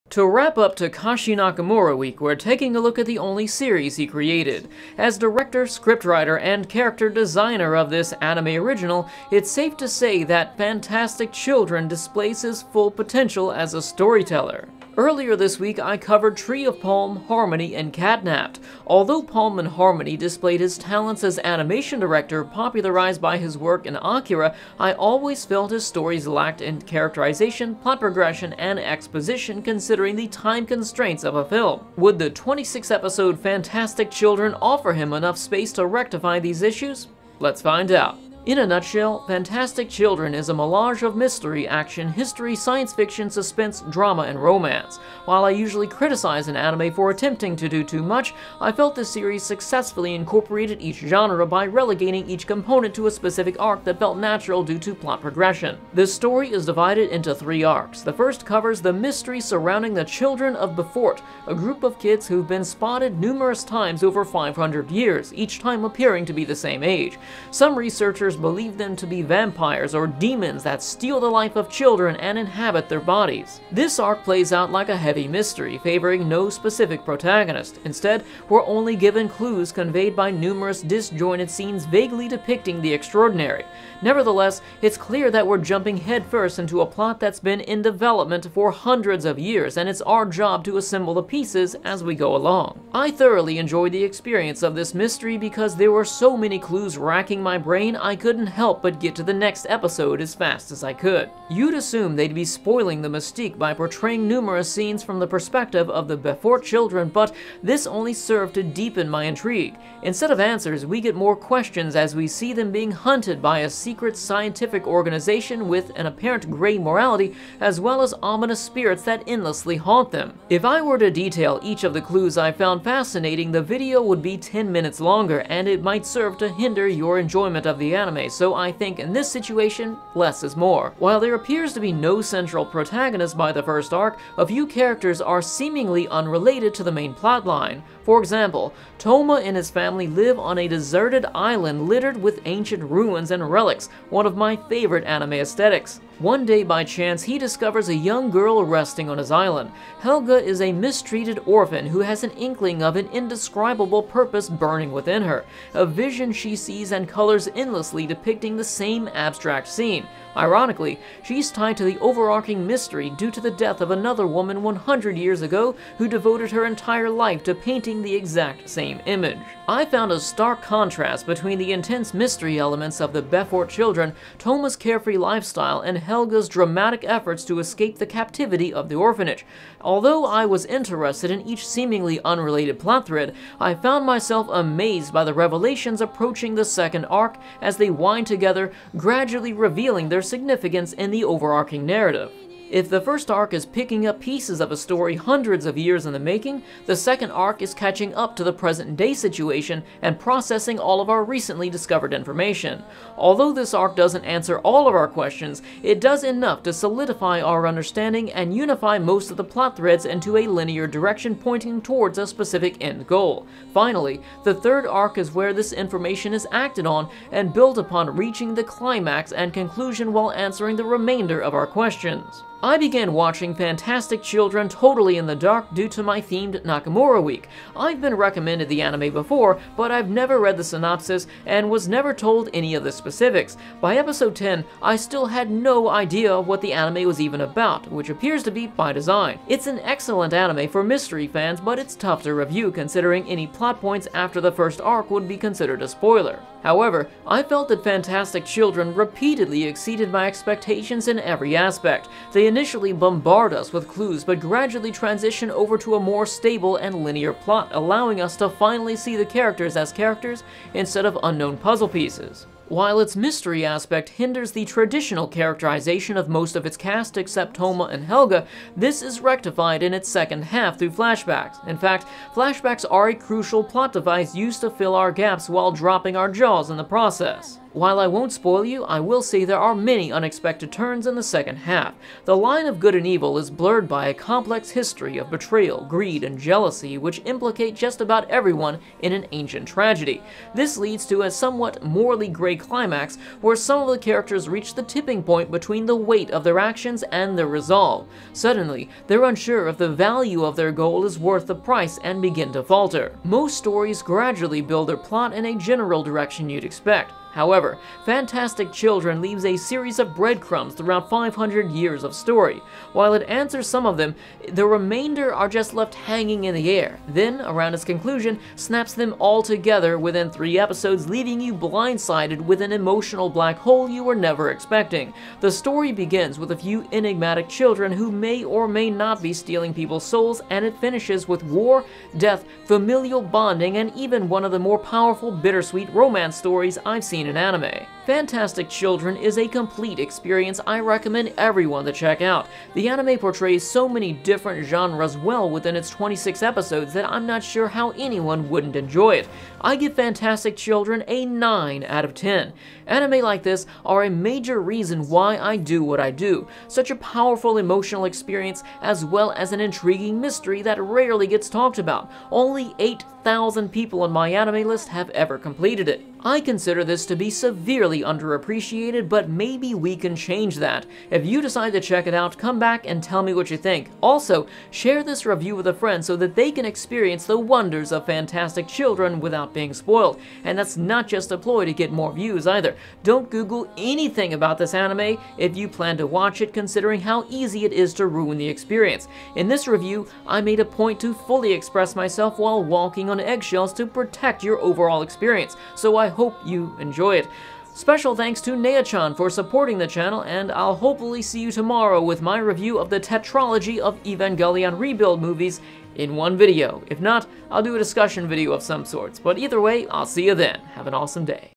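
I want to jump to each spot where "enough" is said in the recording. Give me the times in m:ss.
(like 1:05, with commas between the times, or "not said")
0:35, 3:26.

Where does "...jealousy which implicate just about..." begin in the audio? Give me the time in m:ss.
4:46.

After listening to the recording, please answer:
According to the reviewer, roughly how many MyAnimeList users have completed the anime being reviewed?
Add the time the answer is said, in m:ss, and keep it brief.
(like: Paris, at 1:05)
8,000, at 6:02.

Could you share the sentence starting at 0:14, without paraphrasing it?
Earlier this week, I covered Tree of Palm, Harmony, and Catnapped.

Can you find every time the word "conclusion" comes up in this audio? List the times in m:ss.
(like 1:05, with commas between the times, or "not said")
3:39, 5:17.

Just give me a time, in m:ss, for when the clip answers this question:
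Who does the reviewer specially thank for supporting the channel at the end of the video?
6:38.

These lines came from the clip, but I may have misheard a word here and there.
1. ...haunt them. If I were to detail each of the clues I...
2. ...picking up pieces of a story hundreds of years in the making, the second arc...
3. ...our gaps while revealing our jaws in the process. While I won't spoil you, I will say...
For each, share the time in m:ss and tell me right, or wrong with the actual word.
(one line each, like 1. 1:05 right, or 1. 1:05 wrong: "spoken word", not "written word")
1. 1:59 right
2. 3:13 right
3. 4:34 wrong: "dropping", not "revealing".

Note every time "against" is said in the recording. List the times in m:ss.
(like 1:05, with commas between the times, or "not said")
not said.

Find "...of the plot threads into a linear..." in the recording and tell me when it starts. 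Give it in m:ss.
3:29.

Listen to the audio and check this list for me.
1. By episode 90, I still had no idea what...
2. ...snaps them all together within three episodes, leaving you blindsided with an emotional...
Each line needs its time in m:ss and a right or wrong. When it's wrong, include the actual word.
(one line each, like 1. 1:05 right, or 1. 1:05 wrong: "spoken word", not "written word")
1. 3:53 wrong: "10", not "90"
2. 5:18 right.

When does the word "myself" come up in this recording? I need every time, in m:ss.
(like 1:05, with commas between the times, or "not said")
3:04, 6:31.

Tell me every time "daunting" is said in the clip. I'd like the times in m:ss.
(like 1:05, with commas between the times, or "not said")
not said.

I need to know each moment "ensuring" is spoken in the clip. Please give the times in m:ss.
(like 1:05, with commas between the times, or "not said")
not said.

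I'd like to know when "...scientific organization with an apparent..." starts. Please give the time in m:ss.
1:54.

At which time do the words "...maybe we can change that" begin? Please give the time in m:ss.
6:09.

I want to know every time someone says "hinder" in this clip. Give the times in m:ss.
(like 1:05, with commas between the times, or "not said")
2:06, 4:24.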